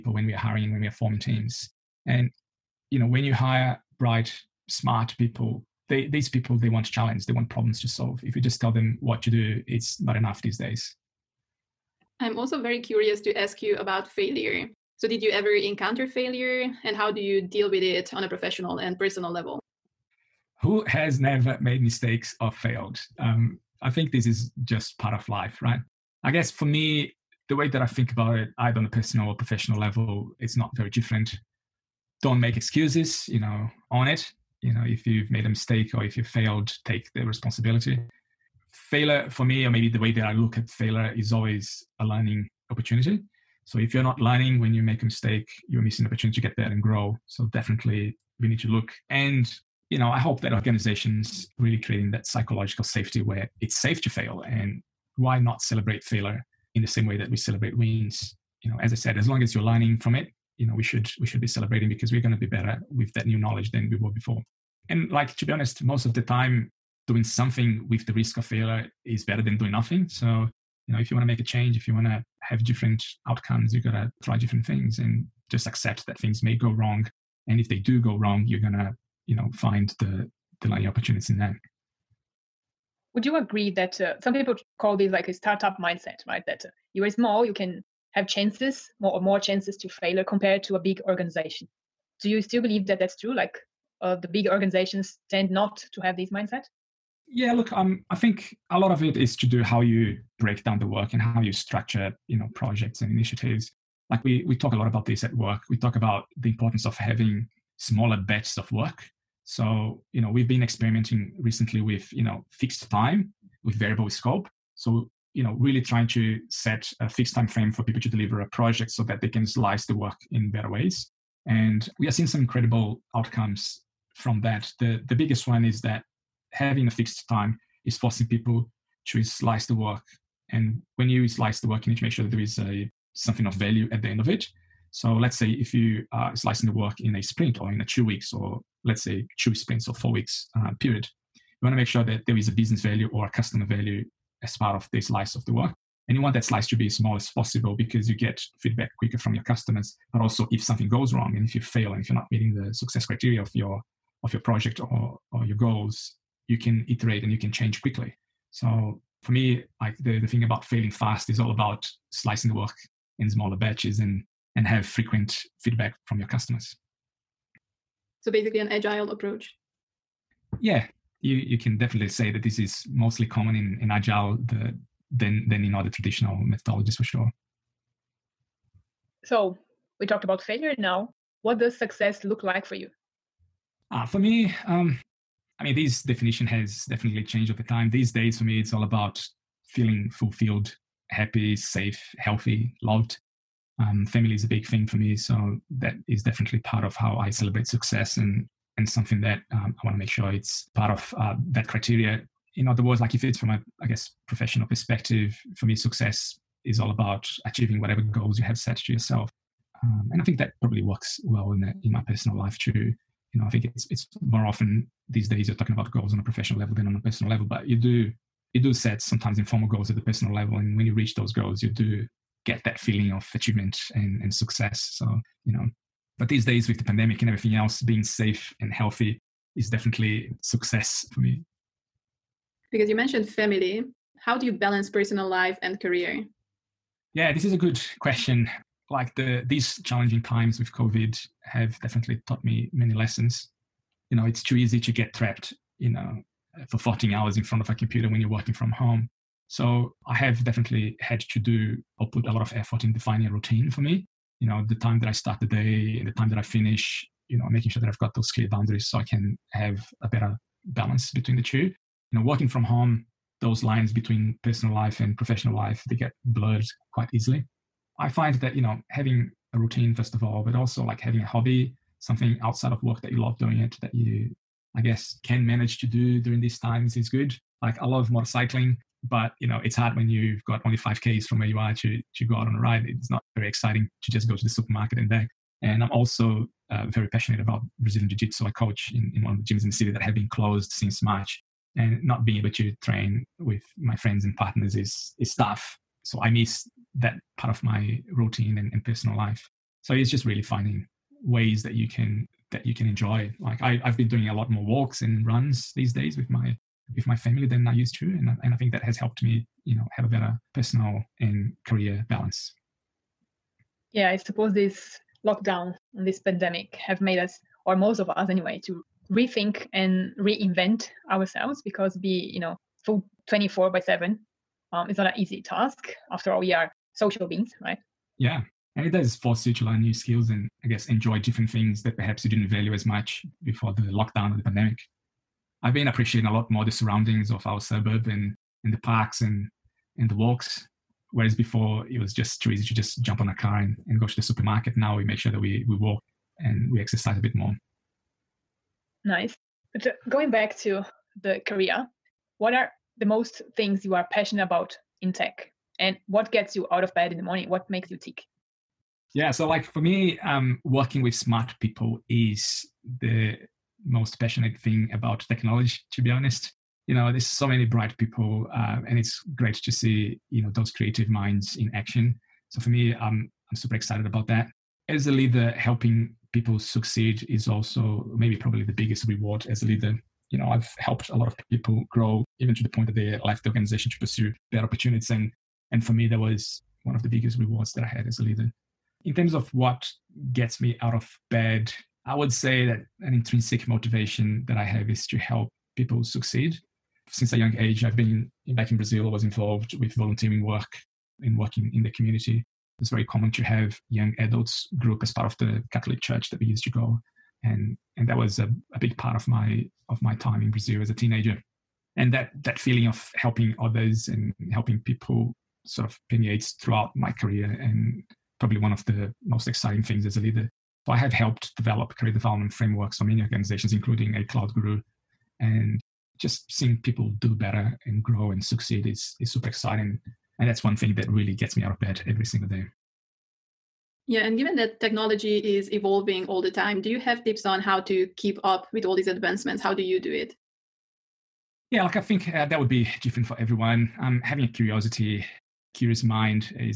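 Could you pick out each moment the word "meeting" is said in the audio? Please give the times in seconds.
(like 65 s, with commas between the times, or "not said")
152 s.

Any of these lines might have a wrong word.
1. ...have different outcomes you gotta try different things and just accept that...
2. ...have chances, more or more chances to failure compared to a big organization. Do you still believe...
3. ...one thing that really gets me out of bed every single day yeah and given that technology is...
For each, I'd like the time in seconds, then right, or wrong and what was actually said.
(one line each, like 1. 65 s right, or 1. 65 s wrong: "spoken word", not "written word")
1. 72 s right
2. 88 s right
3. 430 s right.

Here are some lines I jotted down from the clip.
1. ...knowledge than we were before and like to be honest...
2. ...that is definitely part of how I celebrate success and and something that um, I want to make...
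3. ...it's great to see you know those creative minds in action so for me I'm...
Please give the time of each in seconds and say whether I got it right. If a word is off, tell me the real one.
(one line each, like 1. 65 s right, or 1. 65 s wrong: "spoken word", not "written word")
1. 63 s right
2. 195 s right
3. 368 s right.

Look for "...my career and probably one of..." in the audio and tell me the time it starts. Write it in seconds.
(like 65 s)
416 s.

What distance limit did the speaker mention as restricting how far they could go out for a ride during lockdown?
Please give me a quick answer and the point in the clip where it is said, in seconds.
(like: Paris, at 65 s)
5 km, at 280 s.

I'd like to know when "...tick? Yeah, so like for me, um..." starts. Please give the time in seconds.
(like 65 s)
357 s.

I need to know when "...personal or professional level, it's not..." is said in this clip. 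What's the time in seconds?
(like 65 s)
28 s.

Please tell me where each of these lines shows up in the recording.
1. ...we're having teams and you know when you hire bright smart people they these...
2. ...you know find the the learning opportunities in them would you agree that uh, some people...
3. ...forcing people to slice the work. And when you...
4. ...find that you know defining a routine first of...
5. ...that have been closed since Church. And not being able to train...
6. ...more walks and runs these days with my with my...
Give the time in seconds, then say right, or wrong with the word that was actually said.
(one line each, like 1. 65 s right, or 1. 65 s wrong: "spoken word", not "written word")
1. 0 s wrong: "forming", not "having"
2. 79 s right
3. 127 s right
4. 268 s wrong: "having", not "defining"
5. 289 s wrong: "March", not "Church"
6. 304 s right.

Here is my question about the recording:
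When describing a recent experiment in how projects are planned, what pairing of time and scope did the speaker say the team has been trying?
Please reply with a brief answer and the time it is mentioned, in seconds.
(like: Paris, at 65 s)
Fixed time with variable scope, at 112 s.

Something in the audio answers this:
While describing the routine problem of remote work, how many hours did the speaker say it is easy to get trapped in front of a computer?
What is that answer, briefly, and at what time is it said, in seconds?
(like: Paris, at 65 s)
14, at 246 s.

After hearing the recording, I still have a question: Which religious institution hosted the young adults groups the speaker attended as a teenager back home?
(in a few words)
The Catholic Church.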